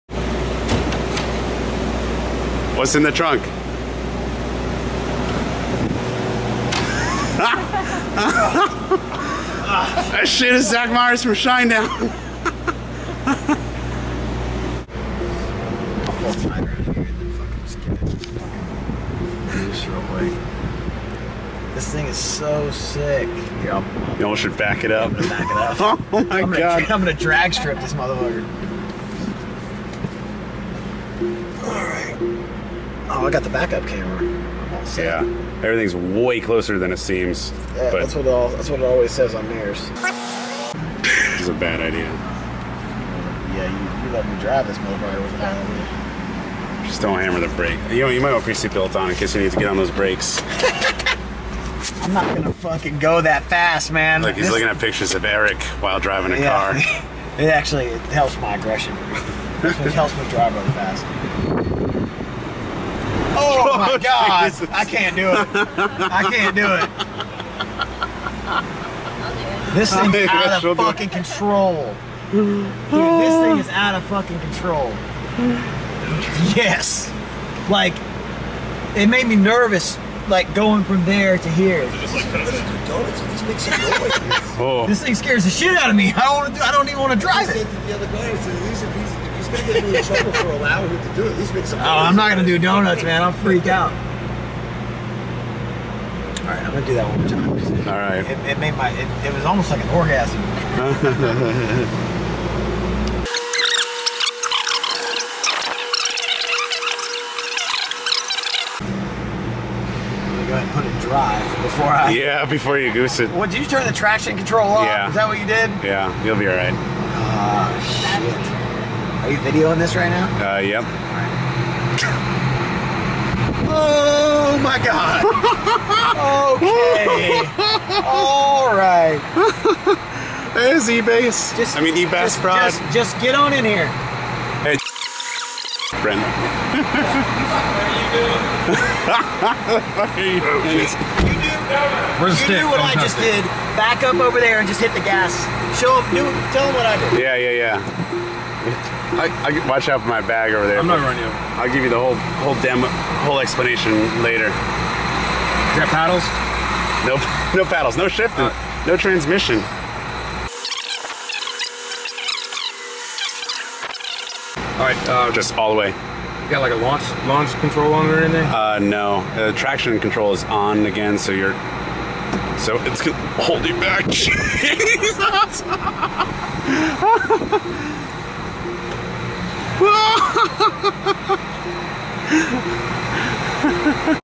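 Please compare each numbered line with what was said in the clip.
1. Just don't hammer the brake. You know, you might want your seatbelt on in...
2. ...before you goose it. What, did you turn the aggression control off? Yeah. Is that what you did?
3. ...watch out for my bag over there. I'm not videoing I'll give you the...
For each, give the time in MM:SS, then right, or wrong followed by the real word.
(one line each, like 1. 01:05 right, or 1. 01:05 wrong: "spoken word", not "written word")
1. 00:46 right
2. 01:52 wrong: "traction", not "aggression"
3. 02:29 wrong: "running", not "videoing".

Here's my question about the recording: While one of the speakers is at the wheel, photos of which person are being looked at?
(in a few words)
Eric.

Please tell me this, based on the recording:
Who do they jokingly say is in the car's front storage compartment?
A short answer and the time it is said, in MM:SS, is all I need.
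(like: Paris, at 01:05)
Zach Myers, at 00:10.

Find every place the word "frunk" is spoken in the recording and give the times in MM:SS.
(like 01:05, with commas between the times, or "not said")
00:03.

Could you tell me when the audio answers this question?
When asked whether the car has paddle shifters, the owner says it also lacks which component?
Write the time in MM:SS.
02:38.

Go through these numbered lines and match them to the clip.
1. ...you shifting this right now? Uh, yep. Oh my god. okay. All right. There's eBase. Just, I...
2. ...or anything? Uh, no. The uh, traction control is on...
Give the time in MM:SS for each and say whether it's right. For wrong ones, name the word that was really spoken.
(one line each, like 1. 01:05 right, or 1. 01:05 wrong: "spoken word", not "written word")
1. 01:59 wrong: "videoing", not "shifting"
2. 02:48 right.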